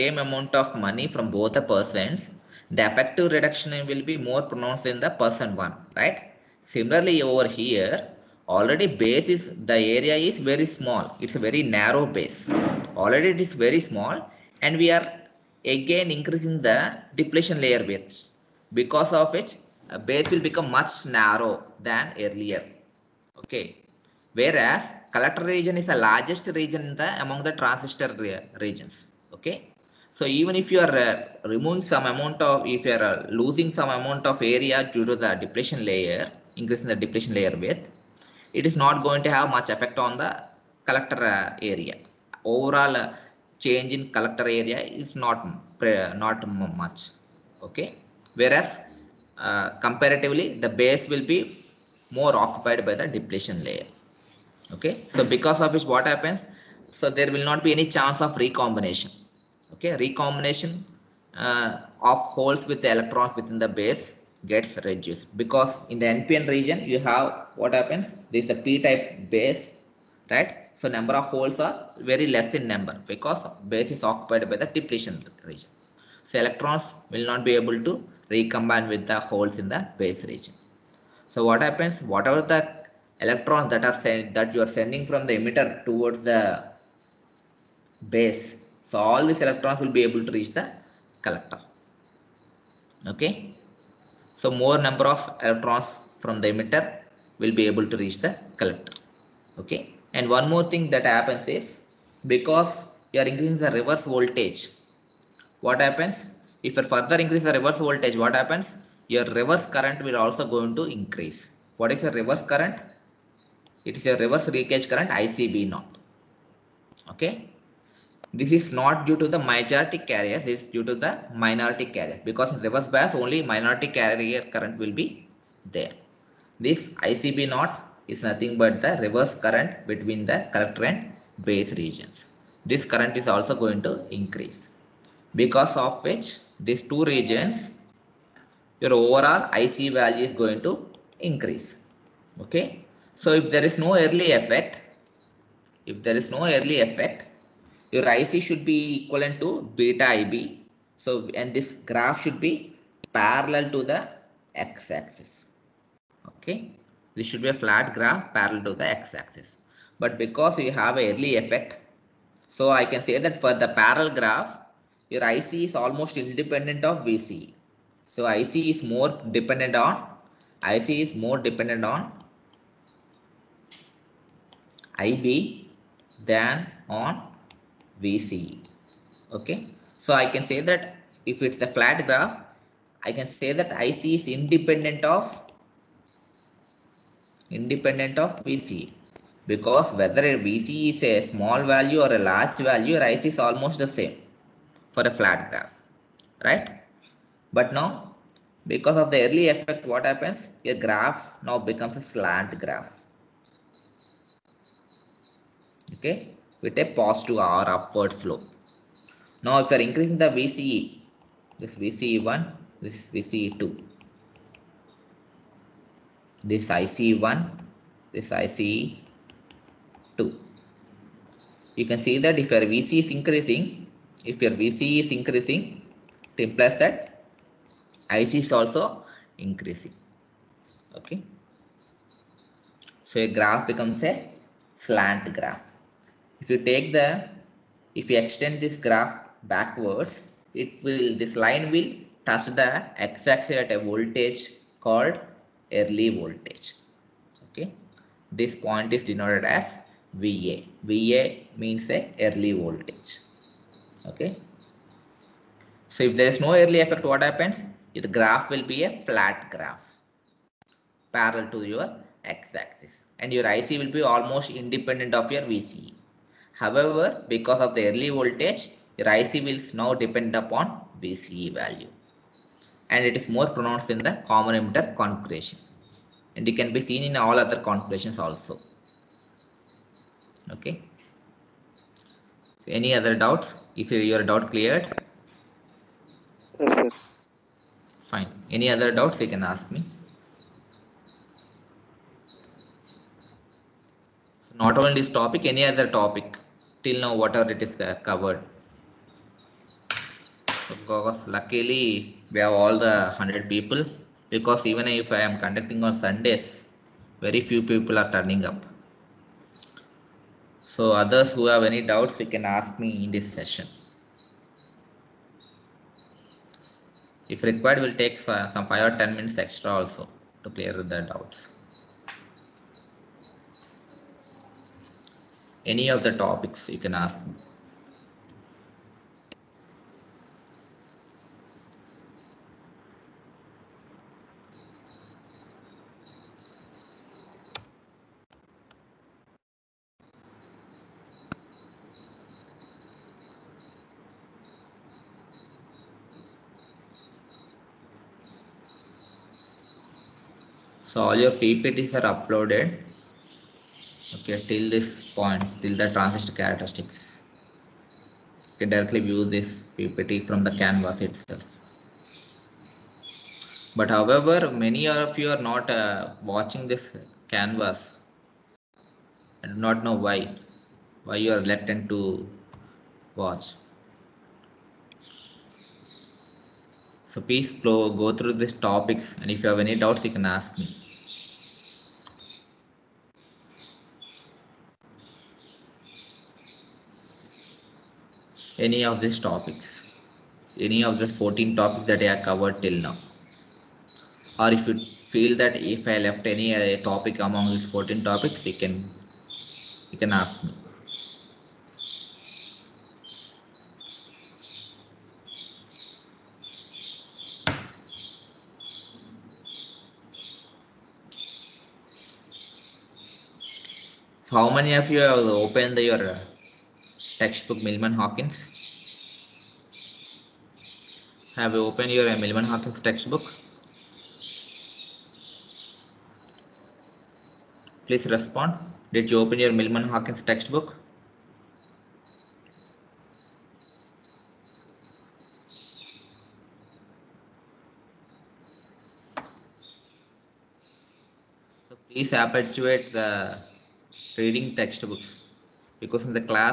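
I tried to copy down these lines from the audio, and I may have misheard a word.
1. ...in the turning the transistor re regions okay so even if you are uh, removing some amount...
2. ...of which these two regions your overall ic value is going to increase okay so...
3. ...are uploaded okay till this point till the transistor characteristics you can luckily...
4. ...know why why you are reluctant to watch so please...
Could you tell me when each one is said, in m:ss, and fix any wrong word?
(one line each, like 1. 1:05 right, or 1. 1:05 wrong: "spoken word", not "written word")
1. 0:26 wrong: "among", not "turning"
2. 2:15 right
3. 5:51 wrong: "directly", not "luckily"
4. 6:09 right.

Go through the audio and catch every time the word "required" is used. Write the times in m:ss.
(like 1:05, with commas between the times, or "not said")
5:17.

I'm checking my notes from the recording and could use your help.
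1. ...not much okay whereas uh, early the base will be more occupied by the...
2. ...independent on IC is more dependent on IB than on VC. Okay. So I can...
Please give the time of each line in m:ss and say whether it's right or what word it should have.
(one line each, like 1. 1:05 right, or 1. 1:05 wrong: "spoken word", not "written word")
1. 0:46 wrong: "comparatively", not "early"
2. 2:49 wrong: "dependent", not "independent".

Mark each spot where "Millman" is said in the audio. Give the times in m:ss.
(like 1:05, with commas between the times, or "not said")
6:57, 7:09.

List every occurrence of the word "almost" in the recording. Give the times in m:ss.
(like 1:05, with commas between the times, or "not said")
2:45, 3:13, 4:24.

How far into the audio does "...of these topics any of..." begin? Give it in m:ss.
6:28.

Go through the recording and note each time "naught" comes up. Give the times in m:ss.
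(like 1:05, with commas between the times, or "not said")
1:55, 2:07.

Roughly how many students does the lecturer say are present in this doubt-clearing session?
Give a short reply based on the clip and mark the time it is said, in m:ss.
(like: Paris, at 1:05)
100, at 5:03.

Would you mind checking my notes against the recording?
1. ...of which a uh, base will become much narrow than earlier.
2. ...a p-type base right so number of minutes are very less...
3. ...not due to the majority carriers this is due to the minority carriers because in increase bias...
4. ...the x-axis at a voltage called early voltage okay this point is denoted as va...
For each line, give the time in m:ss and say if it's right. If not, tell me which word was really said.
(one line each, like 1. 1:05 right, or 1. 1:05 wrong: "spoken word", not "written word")
1. 0:19 right
2. 1:08 wrong: "holes", not "minutes"
3. 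1:58 wrong: "reverse", not "increase"
4. 4:02 right.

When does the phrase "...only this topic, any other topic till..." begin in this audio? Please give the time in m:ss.
4:54.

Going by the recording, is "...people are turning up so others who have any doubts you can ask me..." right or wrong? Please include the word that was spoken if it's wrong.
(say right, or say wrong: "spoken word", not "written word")
right.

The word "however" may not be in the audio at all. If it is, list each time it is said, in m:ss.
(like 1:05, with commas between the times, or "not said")
4:26, 6:03.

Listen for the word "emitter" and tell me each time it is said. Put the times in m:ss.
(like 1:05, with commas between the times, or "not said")
1:25, 1:36, 4:34.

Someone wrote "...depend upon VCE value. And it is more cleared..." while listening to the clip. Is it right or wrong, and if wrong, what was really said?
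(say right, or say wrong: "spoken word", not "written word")
wrong: "pronounced", not "cleared".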